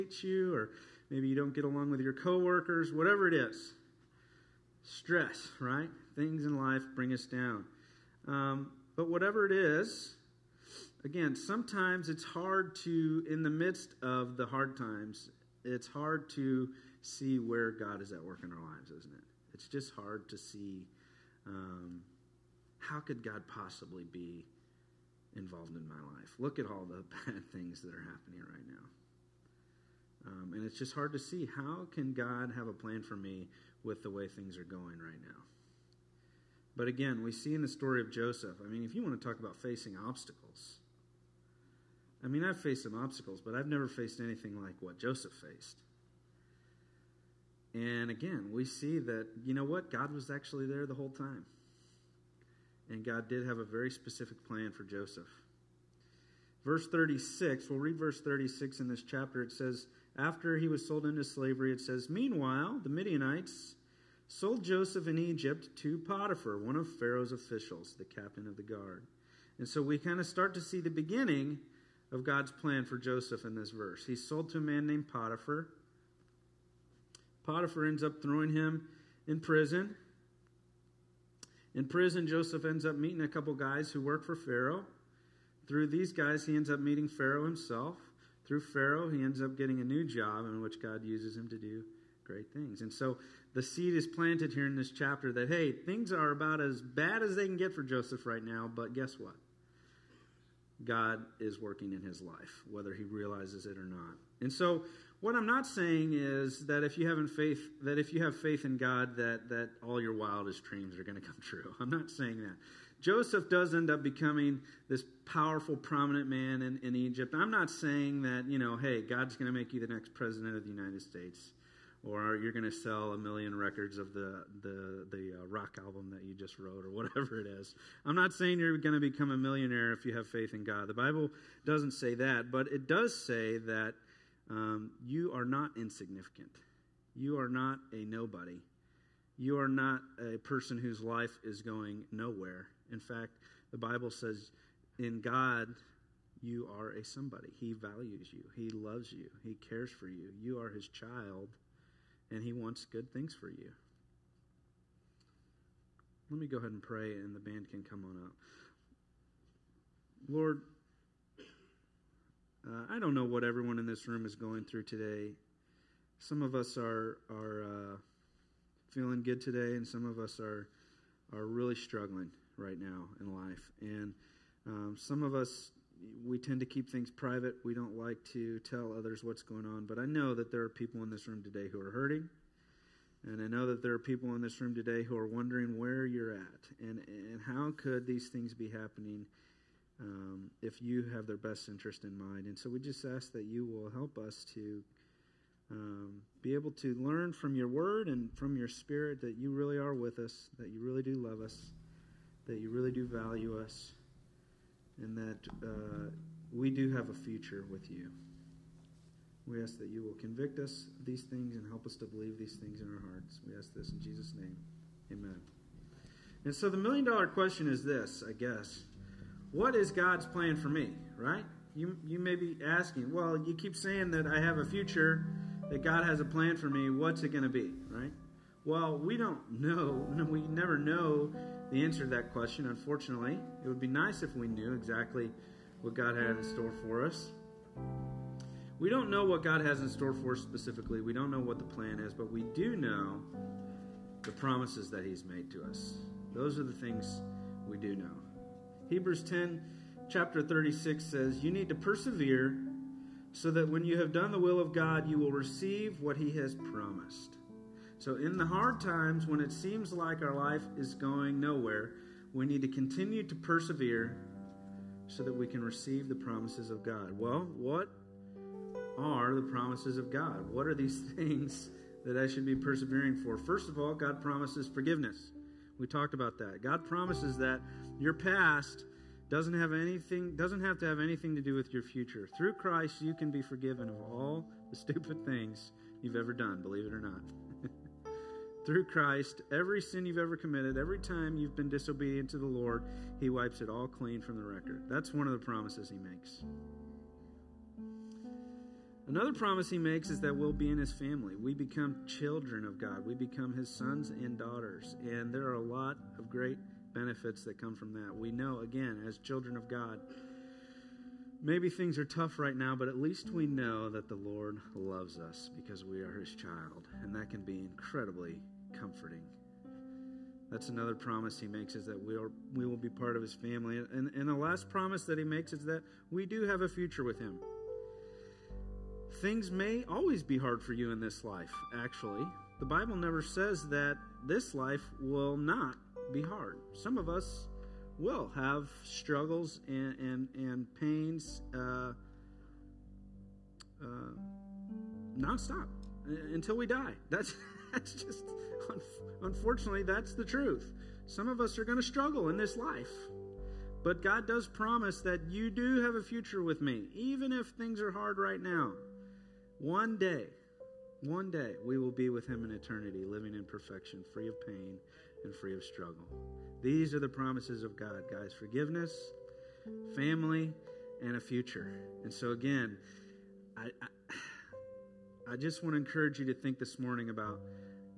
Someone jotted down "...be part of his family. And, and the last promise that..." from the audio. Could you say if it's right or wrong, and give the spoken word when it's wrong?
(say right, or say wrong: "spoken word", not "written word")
right.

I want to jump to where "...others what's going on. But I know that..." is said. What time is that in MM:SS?
02:58.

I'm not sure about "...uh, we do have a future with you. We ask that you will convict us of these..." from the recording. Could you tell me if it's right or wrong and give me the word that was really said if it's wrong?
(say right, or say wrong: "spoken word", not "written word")
right.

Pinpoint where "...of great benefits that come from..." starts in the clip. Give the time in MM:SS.
05:06.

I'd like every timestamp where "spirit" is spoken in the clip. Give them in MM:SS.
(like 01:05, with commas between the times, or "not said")
03:18.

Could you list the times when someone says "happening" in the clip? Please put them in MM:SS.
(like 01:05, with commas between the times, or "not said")
00:28, 03:08.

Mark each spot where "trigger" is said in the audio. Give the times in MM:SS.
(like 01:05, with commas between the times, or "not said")
not said.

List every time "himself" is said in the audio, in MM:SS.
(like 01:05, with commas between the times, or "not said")
01:27.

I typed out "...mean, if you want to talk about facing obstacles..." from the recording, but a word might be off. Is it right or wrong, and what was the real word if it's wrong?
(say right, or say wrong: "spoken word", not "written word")
right.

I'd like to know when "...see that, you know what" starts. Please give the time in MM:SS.
00:48.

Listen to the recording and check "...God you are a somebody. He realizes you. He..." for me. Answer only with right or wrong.
wrong.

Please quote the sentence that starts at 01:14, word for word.
He's sold to a man named Potiphar.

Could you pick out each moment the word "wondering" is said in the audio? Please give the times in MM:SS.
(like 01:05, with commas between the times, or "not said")
03:05.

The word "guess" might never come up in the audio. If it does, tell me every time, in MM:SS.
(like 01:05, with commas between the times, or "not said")
01:38, 03:38.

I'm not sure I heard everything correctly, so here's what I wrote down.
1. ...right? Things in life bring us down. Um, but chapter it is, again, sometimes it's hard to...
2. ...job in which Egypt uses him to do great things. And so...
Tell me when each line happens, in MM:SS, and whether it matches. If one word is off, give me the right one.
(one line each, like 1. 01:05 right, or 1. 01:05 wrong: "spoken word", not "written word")
1. 00:05 wrong: "whatever", not "chapter"
2. 01:30 wrong: "God", not "Egypt".